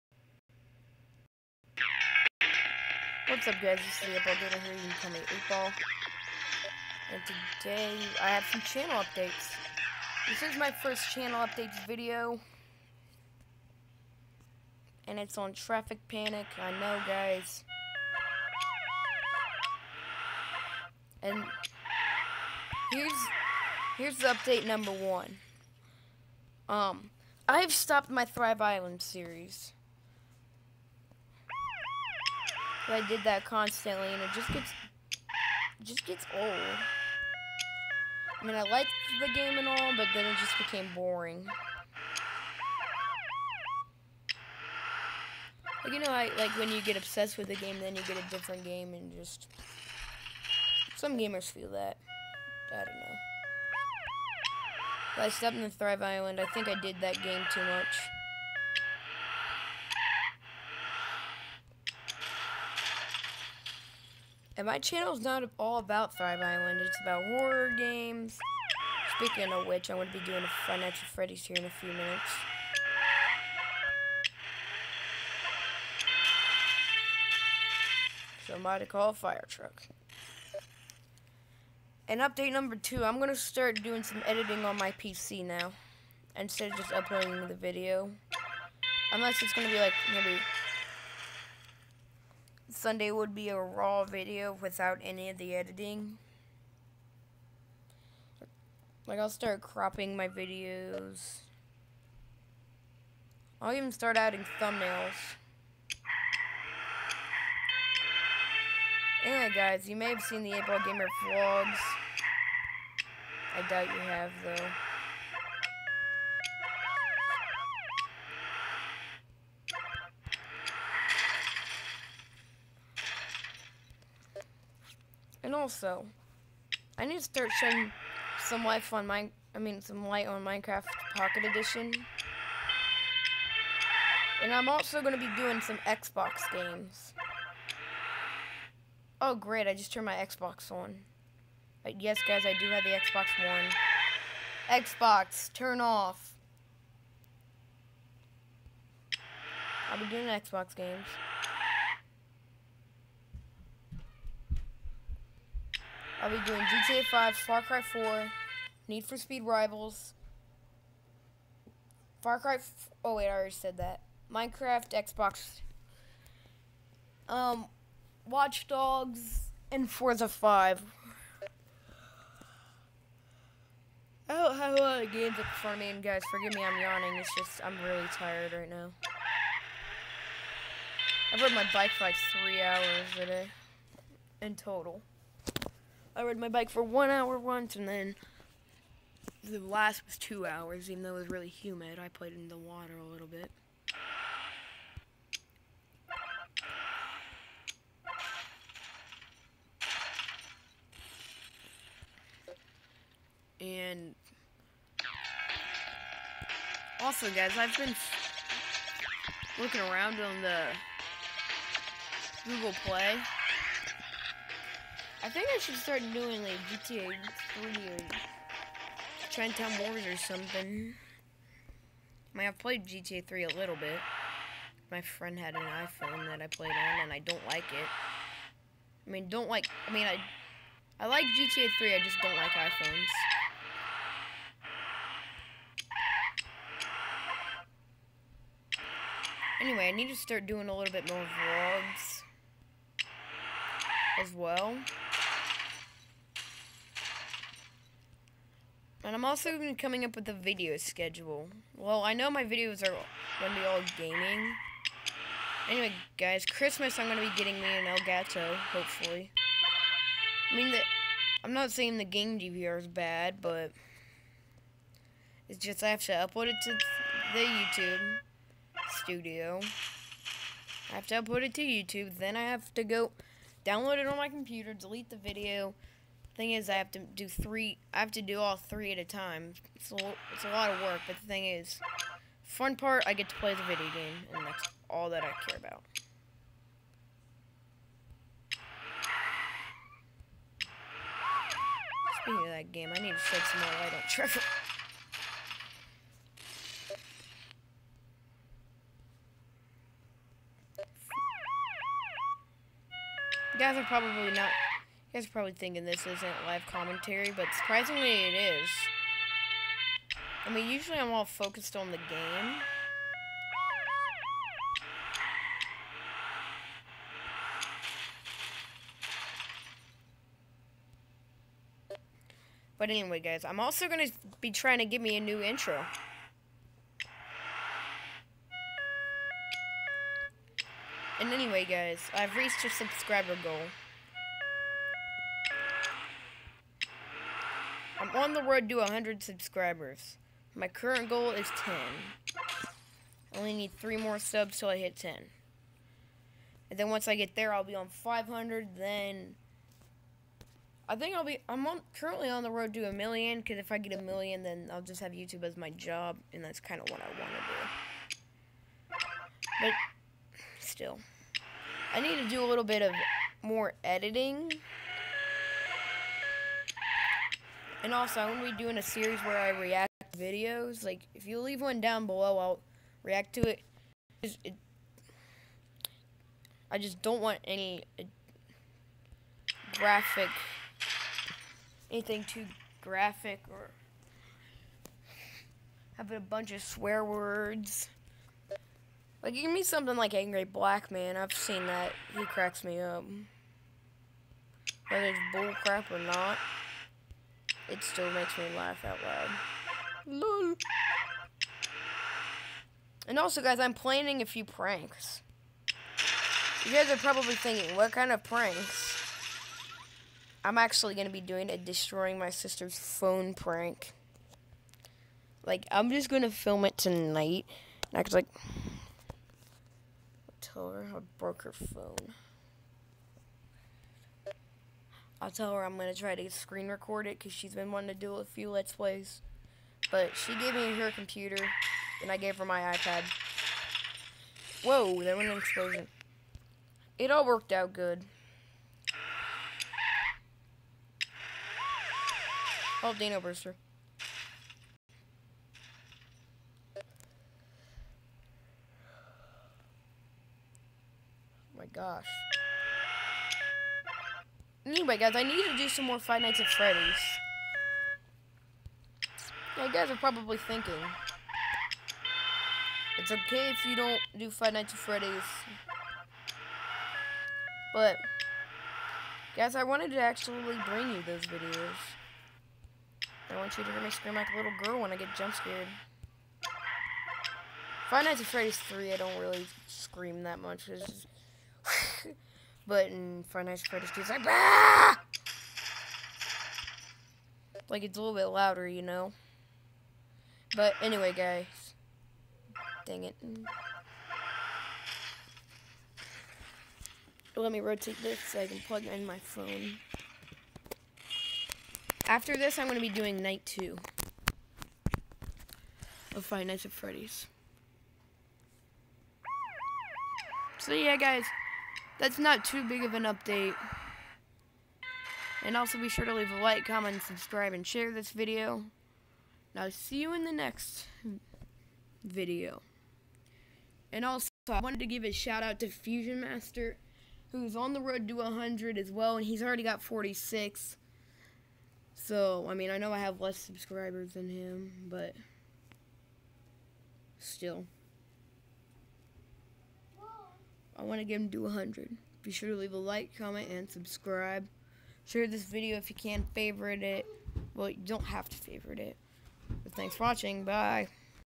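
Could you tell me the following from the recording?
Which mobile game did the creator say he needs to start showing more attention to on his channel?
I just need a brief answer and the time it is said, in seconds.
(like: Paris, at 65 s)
Minecraft Pocket Edition, at 130 s.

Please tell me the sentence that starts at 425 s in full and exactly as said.
I'll tell her I'm going to try to screen record it because she's been wanting to do a few Let's Plays.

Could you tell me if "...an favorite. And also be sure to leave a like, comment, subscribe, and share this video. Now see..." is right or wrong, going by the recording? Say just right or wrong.
wrong.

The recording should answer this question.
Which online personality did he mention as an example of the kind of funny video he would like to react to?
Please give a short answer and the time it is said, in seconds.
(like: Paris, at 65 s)
Angry Black Man, at 390 s.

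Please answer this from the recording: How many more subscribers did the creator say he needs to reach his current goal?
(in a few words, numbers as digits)
3.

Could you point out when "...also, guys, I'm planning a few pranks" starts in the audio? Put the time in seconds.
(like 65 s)
403 s.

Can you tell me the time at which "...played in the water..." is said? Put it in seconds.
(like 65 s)
192 s.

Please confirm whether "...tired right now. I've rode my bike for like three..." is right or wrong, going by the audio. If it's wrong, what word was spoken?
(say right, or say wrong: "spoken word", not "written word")
right.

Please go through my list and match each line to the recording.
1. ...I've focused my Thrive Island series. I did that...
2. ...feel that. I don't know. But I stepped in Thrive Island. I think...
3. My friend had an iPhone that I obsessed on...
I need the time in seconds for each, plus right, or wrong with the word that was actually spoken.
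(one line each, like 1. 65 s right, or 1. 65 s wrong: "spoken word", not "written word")
1. 27 s wrong: "stopped", not "focused"
2. 51 s right
3. 224 s wrong: "played", not "obsessed".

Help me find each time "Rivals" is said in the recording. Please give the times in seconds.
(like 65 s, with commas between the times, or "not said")
159 s.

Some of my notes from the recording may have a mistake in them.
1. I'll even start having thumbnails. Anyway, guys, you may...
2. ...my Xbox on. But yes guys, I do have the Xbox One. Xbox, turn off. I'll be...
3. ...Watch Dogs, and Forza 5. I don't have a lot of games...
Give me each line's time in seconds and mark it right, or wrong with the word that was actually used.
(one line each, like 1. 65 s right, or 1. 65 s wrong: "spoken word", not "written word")
1. 103 s wrong: "adding", not "having"
2. 140 s right
3. 168 s right.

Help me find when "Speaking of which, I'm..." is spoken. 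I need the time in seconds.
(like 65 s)
69 s.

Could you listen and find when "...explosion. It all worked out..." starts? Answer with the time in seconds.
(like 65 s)
435 s.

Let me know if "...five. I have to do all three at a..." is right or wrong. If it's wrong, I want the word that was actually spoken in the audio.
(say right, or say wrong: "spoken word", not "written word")
wrong: "three", not "five".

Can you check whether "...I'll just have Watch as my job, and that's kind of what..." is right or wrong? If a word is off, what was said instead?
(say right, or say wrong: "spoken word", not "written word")
wrong: "YouTube", not "Watch".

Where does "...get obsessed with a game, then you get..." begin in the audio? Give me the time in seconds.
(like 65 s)
46 s.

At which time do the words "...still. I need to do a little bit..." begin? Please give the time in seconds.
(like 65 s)
360 s.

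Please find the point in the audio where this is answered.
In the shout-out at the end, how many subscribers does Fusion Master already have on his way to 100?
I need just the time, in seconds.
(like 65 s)
529 s.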